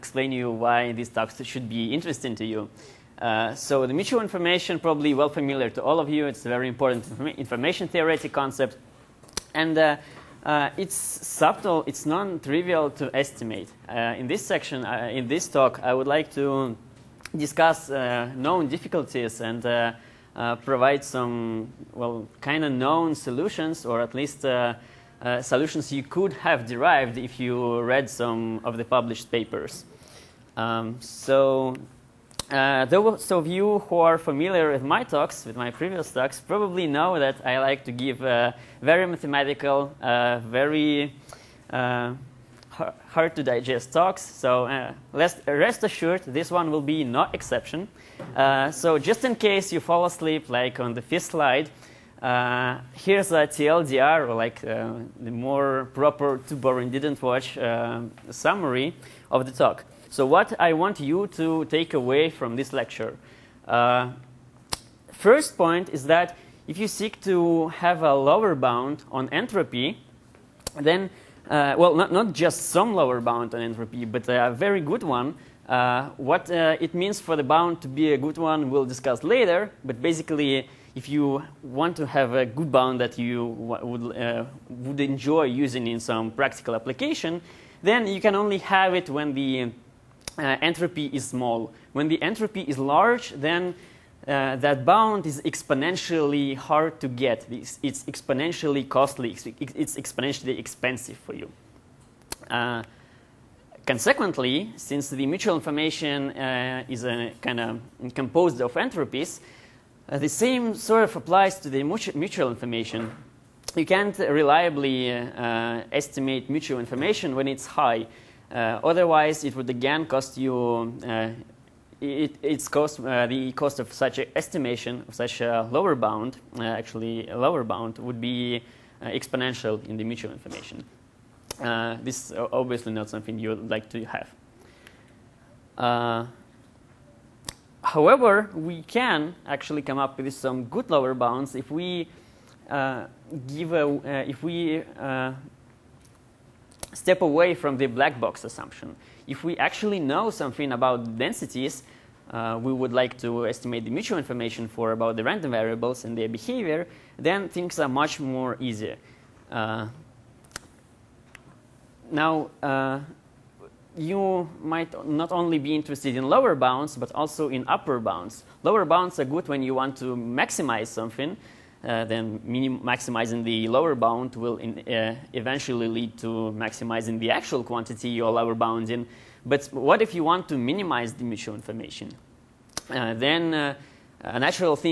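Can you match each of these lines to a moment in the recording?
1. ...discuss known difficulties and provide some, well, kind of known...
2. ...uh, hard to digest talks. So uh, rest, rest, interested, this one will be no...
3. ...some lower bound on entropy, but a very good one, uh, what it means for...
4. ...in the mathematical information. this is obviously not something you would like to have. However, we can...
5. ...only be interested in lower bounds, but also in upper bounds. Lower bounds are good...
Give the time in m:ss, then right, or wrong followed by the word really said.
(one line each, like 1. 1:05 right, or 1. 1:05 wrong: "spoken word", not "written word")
1. 0:17 right
2. 0:41 wrong: "assured", not "interested"
3. 1:12 right
4. 2:09 wrong: "mutual", not "mathematical"
5. 2:45 right.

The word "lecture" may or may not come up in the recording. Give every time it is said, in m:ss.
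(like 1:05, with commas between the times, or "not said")
1:02.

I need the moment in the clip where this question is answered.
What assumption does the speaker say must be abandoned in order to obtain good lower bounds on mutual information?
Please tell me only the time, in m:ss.
2:27.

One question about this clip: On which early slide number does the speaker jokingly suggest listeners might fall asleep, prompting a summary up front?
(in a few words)
5.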